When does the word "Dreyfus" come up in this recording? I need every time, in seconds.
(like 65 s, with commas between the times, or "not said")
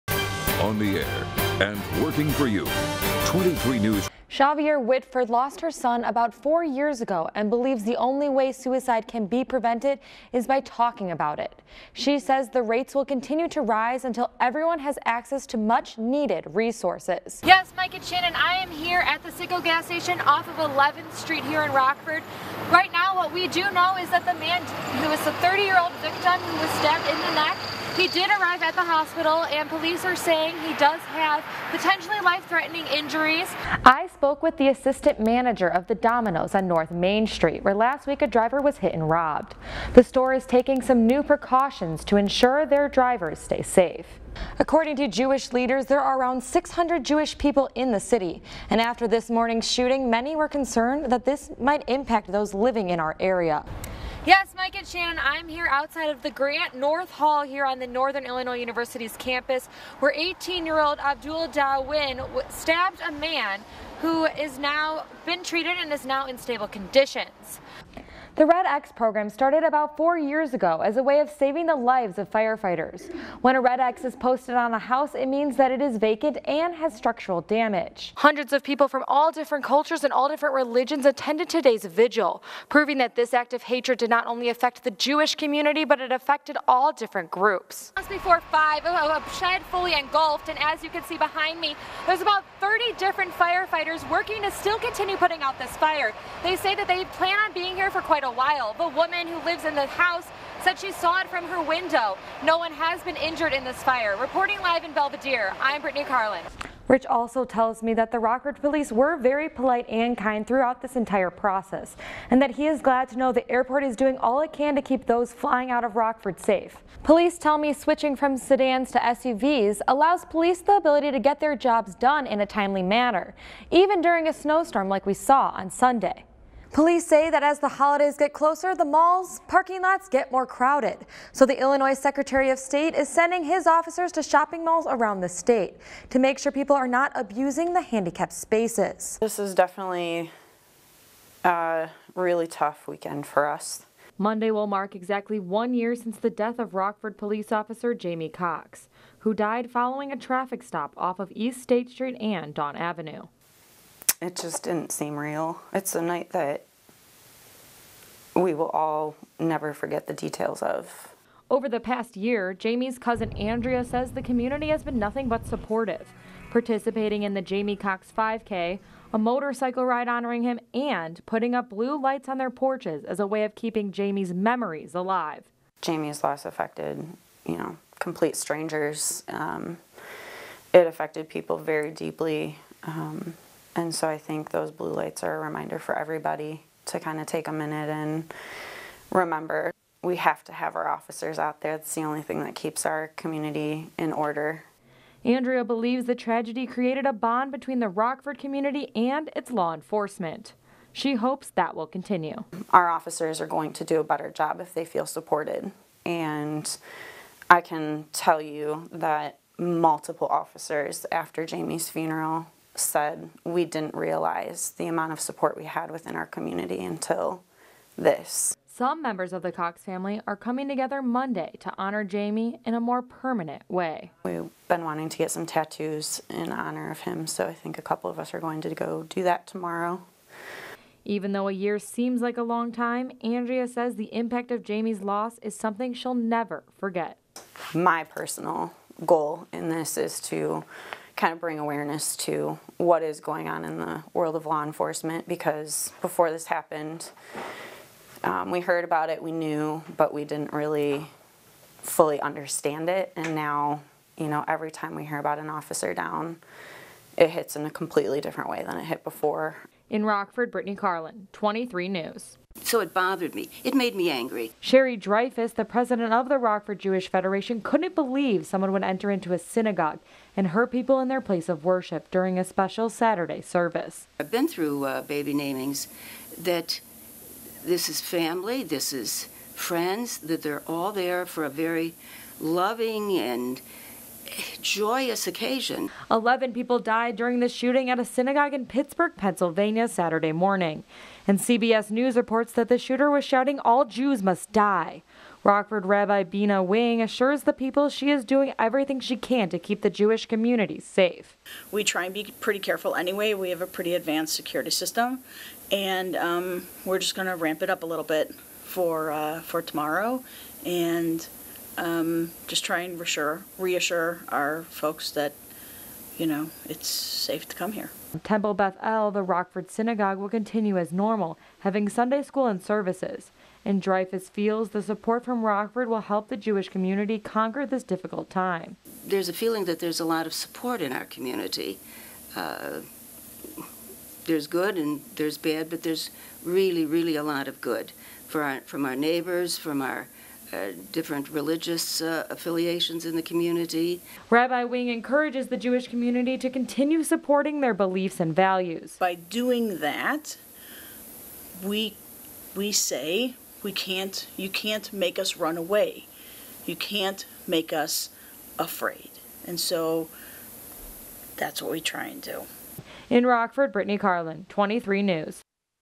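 264 s, 323 s.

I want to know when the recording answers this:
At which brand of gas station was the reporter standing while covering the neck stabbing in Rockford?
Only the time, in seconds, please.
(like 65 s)
19 s.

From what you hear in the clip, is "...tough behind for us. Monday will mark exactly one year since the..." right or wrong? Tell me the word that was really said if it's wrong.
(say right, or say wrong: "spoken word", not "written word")
wrong: "weekend", not "behind".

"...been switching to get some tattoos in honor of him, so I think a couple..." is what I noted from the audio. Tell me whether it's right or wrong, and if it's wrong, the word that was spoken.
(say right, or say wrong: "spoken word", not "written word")
wrong: "wanting", not "switching".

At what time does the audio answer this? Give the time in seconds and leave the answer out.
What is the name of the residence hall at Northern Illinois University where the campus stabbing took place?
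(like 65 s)
56 s.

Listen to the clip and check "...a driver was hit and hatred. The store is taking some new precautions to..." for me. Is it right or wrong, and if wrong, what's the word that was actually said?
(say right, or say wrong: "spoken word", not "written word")
wrong: "robbed", not "hatred".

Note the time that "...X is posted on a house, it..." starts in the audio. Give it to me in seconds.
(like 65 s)
73 s.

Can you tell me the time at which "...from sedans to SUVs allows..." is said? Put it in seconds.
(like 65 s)
118 s.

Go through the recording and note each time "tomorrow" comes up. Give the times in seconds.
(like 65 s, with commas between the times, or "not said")
229 s, 309 s.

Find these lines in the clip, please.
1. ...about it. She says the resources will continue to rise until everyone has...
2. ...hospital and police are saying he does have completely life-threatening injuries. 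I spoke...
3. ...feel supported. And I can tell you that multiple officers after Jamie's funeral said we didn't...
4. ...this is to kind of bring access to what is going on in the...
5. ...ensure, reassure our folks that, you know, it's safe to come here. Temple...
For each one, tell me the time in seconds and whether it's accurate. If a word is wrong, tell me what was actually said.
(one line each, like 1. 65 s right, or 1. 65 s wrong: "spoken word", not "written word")
1. 11 s wrong: "rates", not "resources"
2. 28 s wrong: "potentially", not "completely"
3. 204 s right
4. 239 s wrong: "awareness", not "access"
5. 312 s wrong: "reassure", not "ensure".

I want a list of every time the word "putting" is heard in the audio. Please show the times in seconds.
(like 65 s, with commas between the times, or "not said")
95 s, 171 s.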